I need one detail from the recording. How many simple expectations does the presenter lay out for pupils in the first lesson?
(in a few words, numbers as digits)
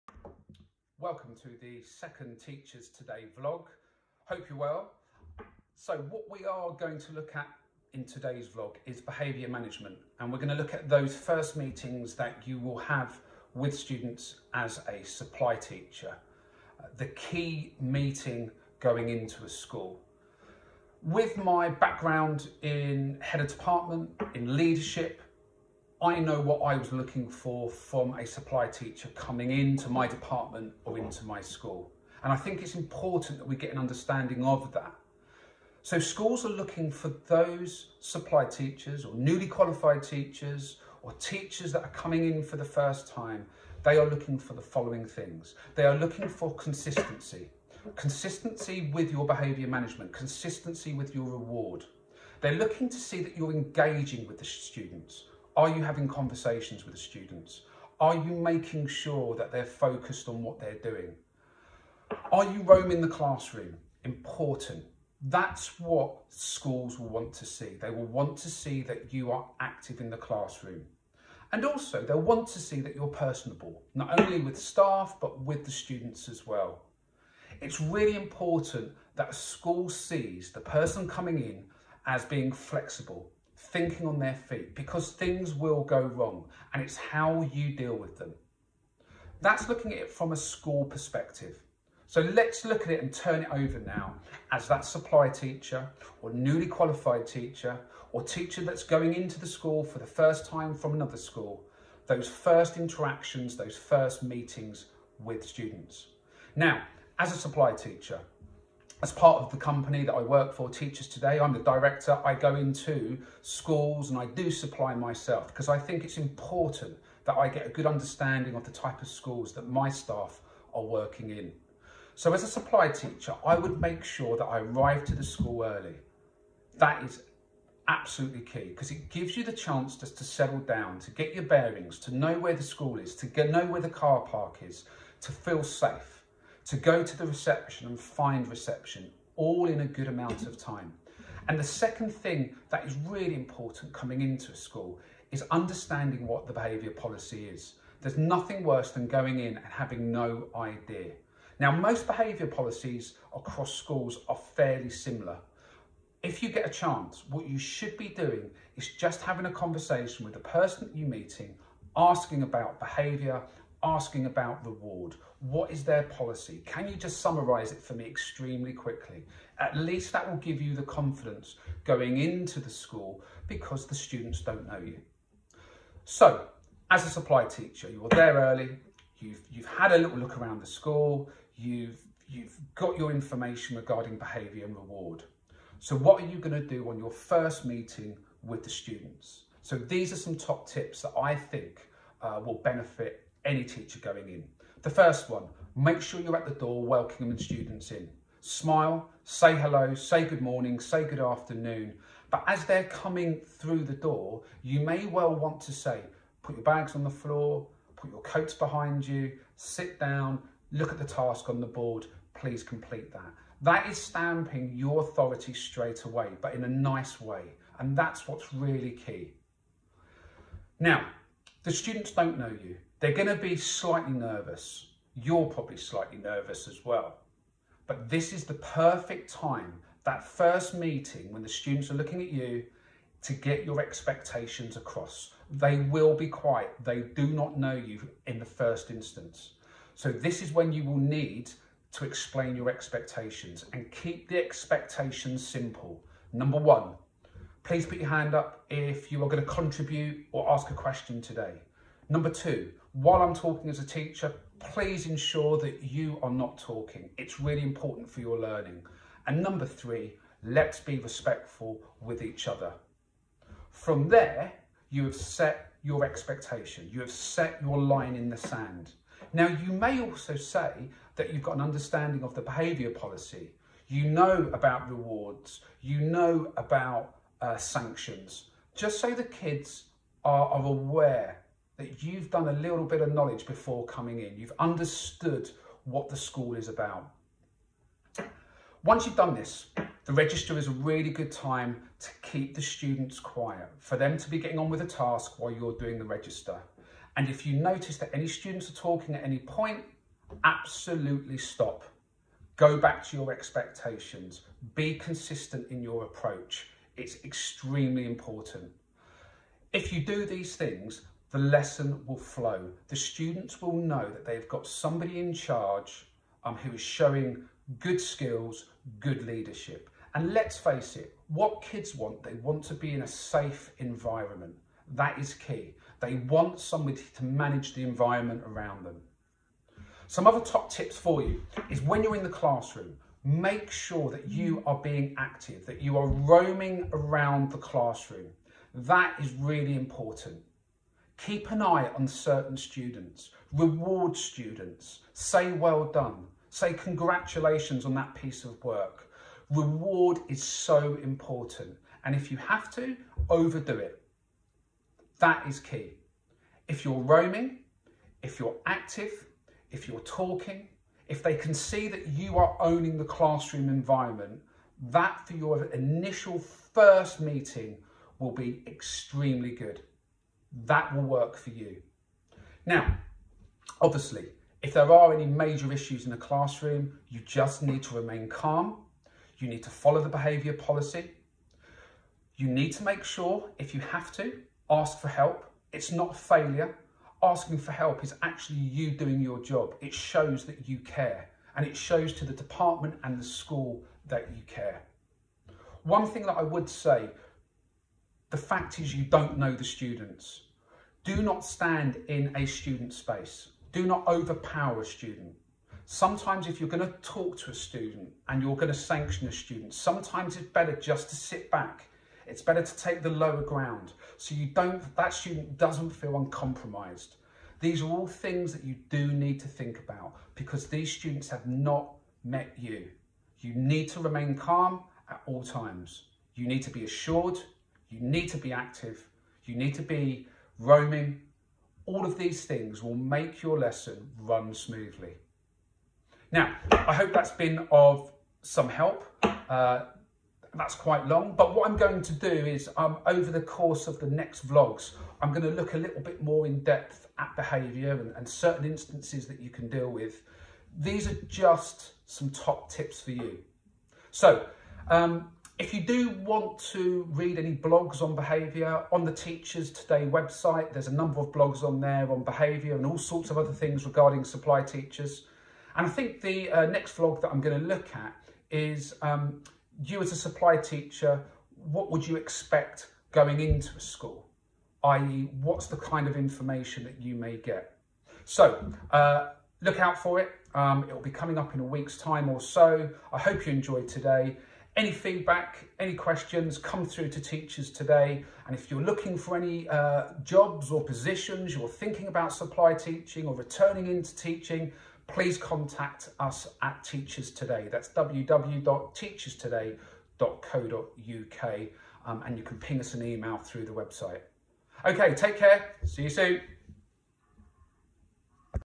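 3.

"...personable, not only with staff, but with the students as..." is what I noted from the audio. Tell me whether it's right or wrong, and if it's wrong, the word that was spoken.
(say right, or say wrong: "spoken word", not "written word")
right.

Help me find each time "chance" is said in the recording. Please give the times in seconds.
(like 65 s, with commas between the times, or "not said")
129 s, 156 s.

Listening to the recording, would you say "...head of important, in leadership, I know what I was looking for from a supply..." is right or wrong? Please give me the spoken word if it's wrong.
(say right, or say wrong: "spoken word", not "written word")
wrong: "department", not "important".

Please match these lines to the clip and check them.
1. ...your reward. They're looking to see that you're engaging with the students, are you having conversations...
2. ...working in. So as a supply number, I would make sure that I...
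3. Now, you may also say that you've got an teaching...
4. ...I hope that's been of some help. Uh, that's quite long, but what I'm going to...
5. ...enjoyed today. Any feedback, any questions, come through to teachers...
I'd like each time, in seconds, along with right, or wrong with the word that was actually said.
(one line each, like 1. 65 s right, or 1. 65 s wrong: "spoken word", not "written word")
1. 51 s right
2. 120 s wrong: "teacher", not "number"
3. 269 s wrong: "understanding", not "teaching"
4. 436 s right
5. 483 s right.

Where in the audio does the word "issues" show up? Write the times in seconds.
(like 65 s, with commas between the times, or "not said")
375 s.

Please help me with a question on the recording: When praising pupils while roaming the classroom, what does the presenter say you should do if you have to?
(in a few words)
Overdo it.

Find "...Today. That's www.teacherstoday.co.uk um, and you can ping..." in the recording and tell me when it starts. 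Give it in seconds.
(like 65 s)
497 s.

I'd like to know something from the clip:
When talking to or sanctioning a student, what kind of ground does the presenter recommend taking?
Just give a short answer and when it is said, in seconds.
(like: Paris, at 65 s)
The lower ground, at 413 s.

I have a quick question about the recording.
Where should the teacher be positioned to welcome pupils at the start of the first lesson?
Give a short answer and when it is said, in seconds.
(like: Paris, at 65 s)
At the door, at 196 s.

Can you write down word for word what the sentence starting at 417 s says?
These are all things that you do need to think about because these students have not met you.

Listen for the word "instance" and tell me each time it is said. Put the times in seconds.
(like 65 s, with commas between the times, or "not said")
238 s, 448 s.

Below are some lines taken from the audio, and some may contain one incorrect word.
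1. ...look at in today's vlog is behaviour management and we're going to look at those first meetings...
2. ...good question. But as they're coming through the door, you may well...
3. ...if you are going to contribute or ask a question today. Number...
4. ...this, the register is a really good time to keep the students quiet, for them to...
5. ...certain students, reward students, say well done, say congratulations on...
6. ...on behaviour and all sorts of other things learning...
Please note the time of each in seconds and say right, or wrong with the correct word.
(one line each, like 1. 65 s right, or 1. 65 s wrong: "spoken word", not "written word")
1. 7 s right
2. 201 s wrong: "afternoon", not "question"
3. 248 s right
4. 289 s right
5. 342 s right
6. 462 s wrong: "regarding", not "learning".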